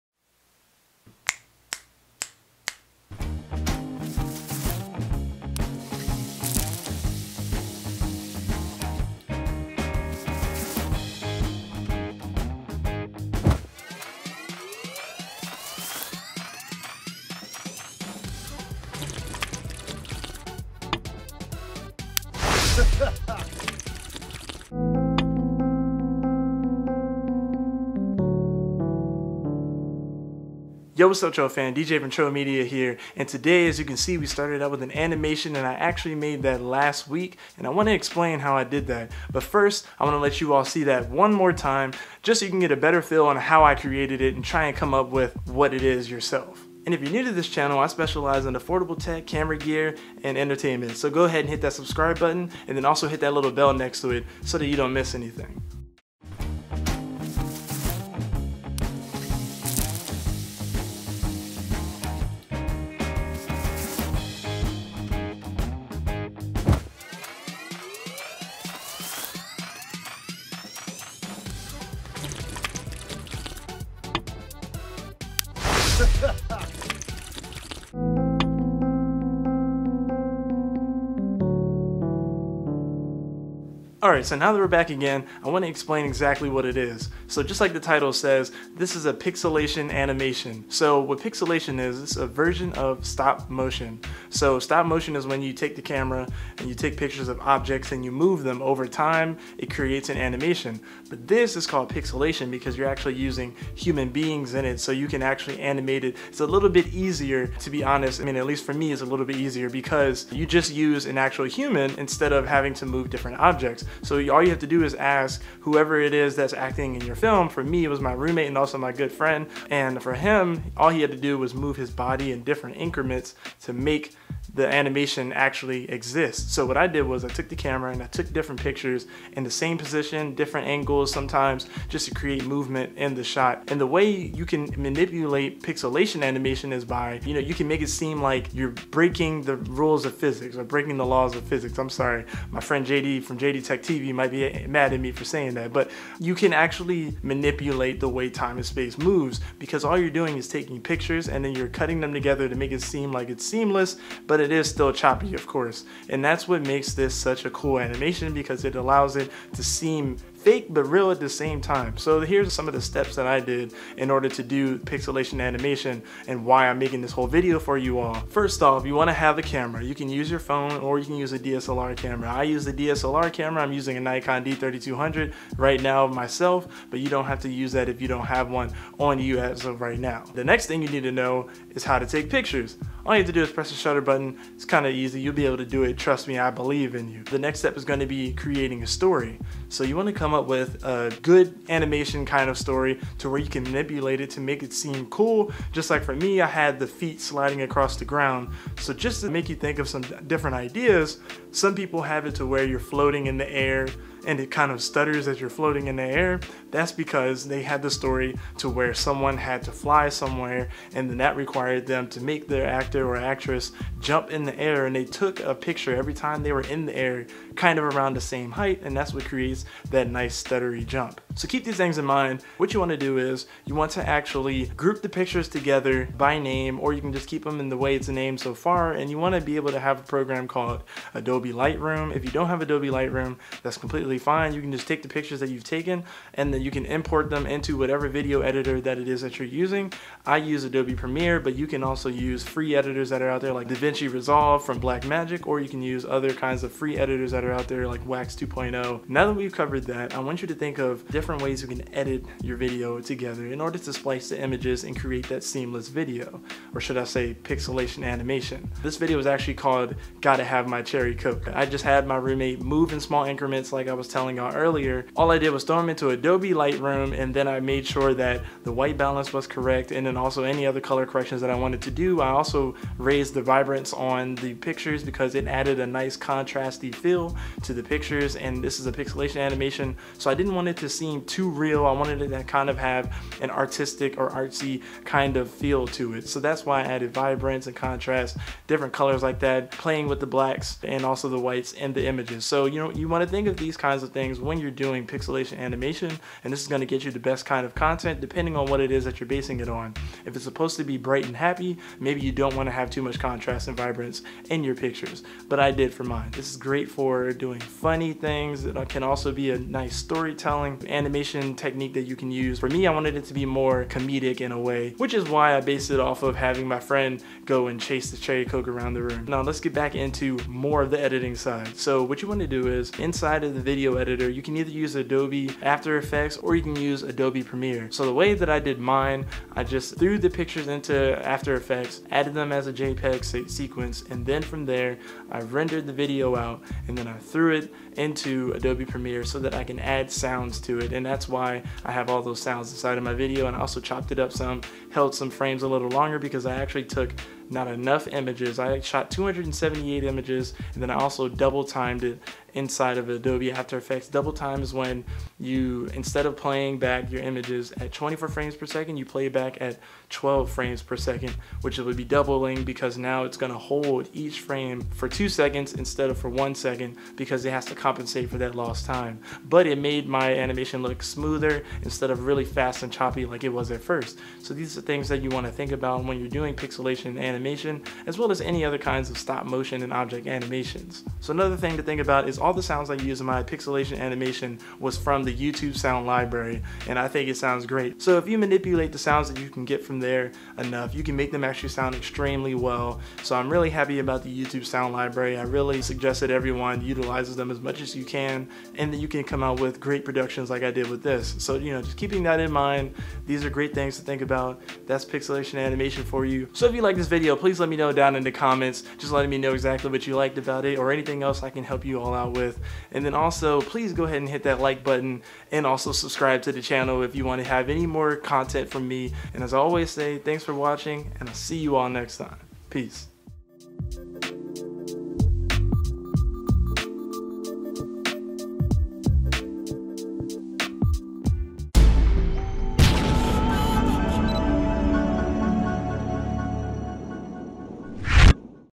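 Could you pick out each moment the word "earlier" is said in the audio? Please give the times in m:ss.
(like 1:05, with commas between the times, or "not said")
4:24.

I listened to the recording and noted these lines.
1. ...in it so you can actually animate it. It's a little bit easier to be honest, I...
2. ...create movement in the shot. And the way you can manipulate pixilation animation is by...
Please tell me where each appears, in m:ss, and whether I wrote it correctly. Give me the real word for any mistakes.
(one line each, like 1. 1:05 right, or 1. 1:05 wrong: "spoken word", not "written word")
1. 1:44 right
2. 2:12 right.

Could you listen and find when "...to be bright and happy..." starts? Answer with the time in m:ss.
5:00.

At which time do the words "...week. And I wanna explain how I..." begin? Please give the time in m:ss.
0:37.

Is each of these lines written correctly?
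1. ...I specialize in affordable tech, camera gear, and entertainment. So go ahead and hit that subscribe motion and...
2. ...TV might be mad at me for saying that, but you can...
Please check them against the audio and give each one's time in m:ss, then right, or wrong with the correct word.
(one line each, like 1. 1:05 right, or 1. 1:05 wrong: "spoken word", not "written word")
1. 0:47 wrong: "button", not "motion"
2. 2:23 right.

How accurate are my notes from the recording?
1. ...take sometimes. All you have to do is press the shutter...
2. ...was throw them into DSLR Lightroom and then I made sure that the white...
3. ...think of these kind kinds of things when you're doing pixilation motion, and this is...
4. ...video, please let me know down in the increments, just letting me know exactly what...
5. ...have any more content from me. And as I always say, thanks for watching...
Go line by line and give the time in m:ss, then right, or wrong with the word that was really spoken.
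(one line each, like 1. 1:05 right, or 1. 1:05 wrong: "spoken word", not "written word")
1. 3:02 wrong: "pictures", not "sometimes"
2. 4:25 wrong: "Adobe", not "DSLR"
3. 4:53 wrong: "animation", not "motion"
4. 6:47 wrong: "comments", not "increments"
5. 6:57 right.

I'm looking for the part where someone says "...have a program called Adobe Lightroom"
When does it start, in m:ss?
3:49.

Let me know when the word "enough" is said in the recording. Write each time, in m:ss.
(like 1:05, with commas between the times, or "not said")
5:47, 6:30.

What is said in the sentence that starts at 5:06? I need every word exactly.
This is great for doing funny things.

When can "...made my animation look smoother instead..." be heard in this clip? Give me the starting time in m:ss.
6:09.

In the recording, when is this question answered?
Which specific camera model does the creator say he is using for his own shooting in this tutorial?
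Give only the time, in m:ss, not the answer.
2:53.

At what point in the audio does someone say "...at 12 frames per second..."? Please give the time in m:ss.
5:59.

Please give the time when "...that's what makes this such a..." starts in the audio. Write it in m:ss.
2:36.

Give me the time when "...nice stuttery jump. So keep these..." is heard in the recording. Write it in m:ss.
3:40.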